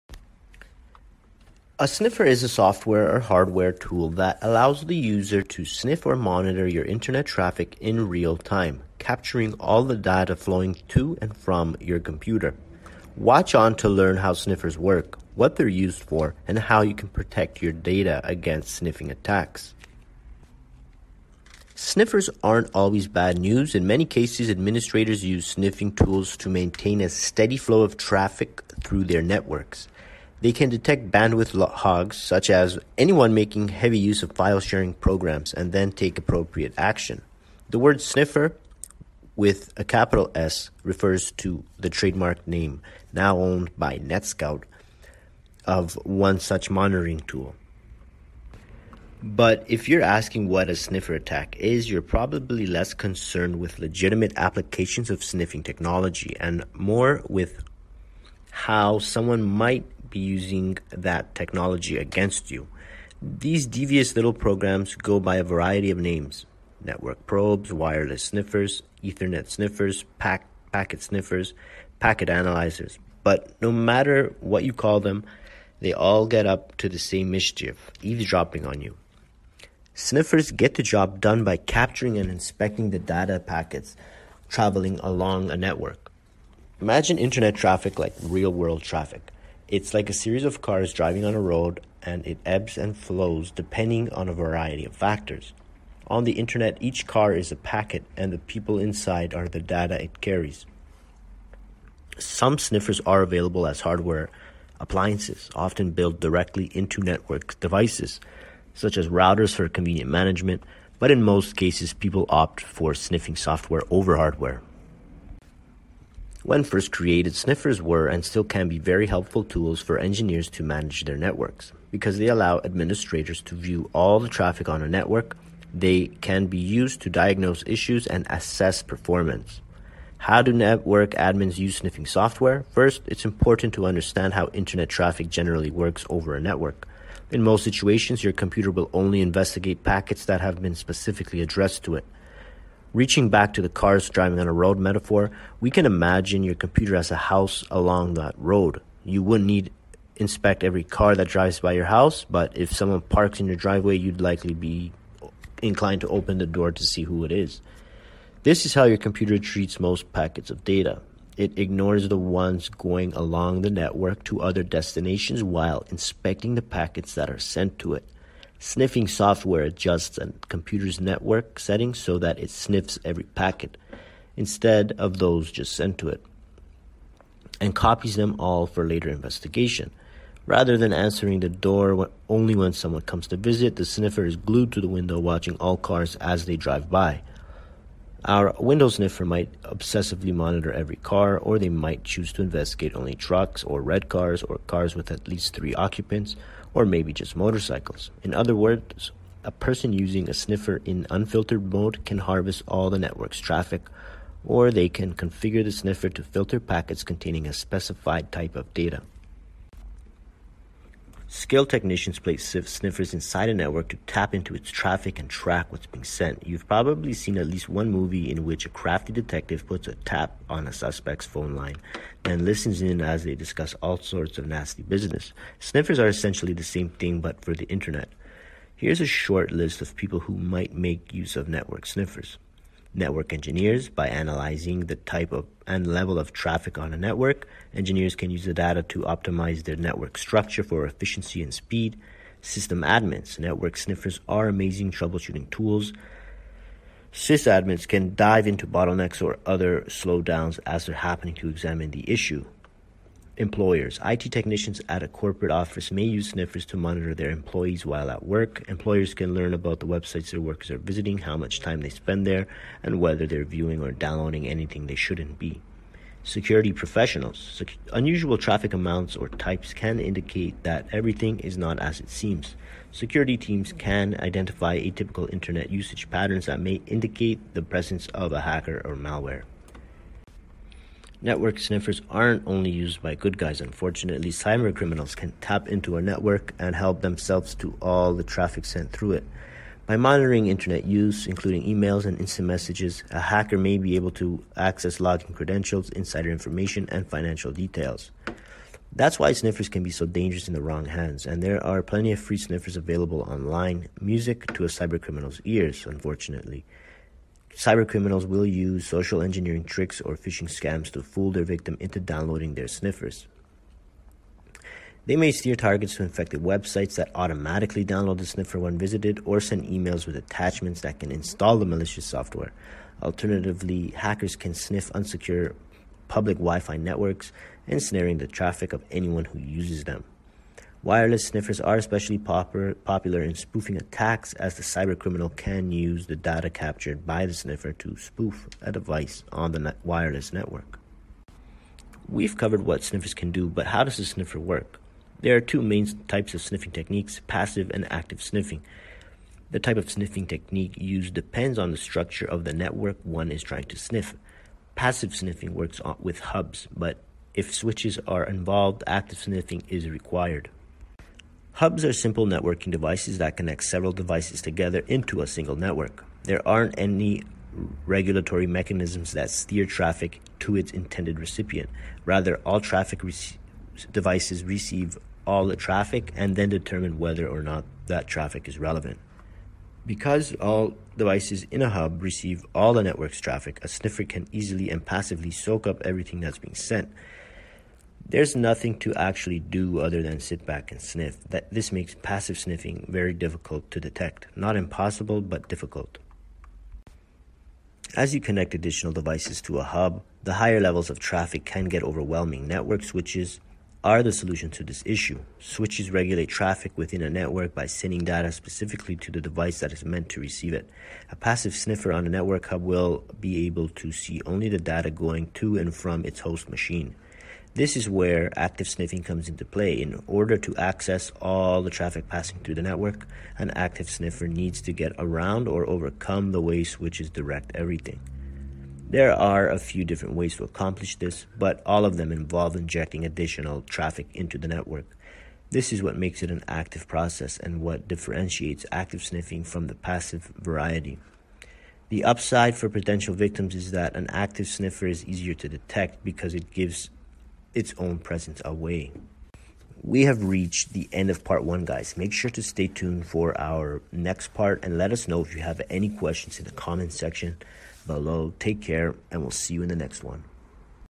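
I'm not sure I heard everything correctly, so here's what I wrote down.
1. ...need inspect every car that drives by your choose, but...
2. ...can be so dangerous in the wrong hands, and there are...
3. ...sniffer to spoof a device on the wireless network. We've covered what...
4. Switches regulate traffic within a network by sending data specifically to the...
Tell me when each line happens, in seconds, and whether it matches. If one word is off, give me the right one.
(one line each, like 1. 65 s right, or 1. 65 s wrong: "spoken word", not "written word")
1. 149 s wrong: "house", not "choose"
2. 299 s right
3. 337 s right
4. 405 s right.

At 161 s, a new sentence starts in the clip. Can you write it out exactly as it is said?
It ignores the ones going along the network to other destinations while inspecting the packets that are sent to it.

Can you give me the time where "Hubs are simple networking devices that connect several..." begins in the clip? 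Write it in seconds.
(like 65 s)
361 s.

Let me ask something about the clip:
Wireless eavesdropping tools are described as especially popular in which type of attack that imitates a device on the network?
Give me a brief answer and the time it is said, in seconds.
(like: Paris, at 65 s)
spoofing attacks, at 333 s.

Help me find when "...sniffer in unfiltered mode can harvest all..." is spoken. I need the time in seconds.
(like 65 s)
200 s.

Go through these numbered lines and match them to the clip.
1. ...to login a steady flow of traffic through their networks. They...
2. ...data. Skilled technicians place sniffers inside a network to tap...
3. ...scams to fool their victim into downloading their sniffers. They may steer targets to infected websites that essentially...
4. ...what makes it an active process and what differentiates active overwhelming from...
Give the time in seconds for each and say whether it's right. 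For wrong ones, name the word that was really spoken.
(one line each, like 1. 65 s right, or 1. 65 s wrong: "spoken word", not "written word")
1. 26 s wrong: "maintain", not "login"
2. 208 s right
3. 310 s wrong: "automatically", not "essentially"
4. 435 s wrong: "sniffing", not "overwhelming".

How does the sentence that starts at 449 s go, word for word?
We have reached the end of part one, guys.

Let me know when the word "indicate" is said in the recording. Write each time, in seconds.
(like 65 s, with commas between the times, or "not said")
270 s, 276 s.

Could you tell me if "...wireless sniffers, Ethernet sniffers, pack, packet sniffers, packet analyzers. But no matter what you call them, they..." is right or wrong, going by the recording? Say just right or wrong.
right.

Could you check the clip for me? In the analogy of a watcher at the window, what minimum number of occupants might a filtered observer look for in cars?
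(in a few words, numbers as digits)
3.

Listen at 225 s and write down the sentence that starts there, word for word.
Sniffers are essentially the same thing but for the internet.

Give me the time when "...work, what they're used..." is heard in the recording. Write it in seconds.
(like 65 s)
14 s.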